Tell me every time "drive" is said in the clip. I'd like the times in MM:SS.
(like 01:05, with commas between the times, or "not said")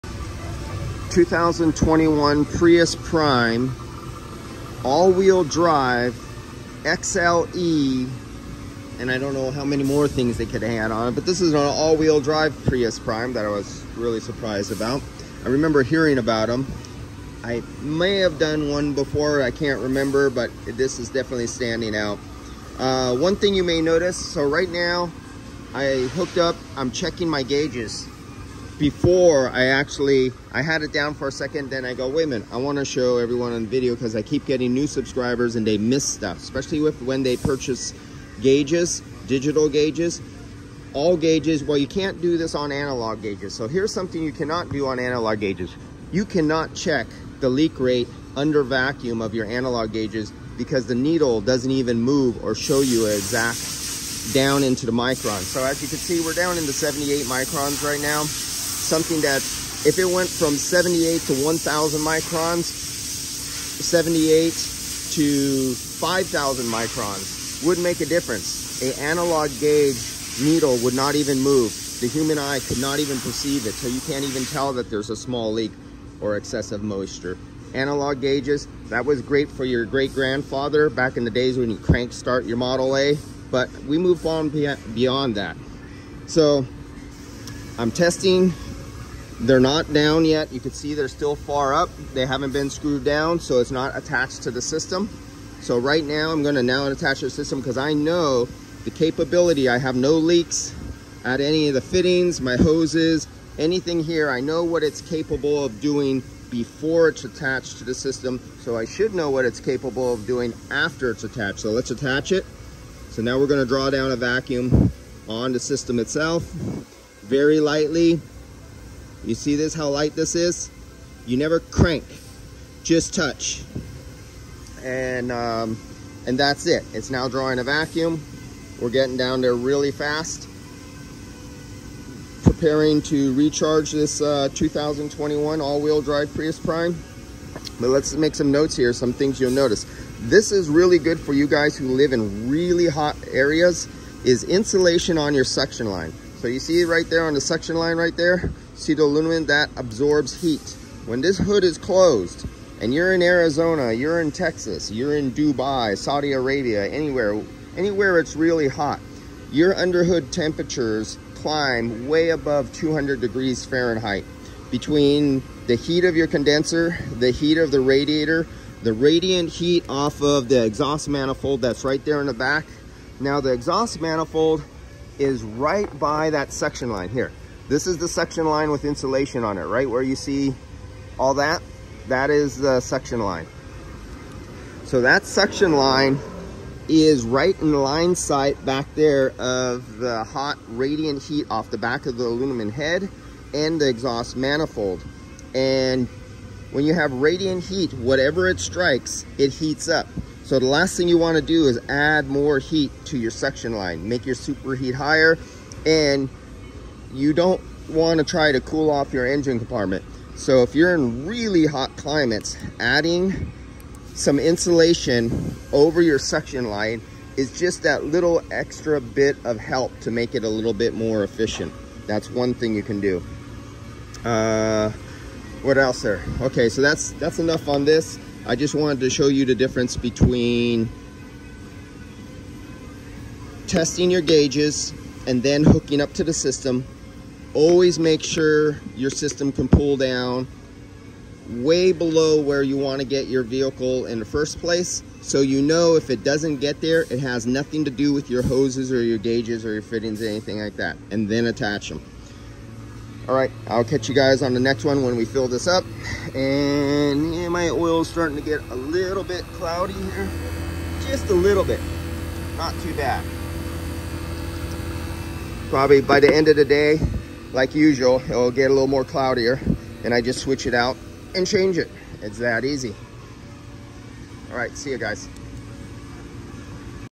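00:05, 00:12, 02:16.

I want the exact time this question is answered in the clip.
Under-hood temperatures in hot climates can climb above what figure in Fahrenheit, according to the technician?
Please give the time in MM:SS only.
02:42.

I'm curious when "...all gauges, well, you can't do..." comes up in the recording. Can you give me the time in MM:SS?
00:40.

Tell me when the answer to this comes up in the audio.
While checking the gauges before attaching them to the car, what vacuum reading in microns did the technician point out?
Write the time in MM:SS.
00:56.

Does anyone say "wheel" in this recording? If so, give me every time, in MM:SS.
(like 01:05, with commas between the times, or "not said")
00:04, 00:11, 02:15.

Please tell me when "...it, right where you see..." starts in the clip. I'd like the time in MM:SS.
02:59.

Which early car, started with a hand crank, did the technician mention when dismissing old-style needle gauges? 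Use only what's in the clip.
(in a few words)
Model A.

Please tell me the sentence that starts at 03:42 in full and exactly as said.
That's one thing you can do.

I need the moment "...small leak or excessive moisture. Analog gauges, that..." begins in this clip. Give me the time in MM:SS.
01:15.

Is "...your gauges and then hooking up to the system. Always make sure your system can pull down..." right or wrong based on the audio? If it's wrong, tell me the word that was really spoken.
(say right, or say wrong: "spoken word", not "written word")
right.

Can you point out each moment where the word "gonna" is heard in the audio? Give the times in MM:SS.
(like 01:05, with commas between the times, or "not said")
01:36, 01:53.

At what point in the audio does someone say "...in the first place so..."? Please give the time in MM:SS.
04:04.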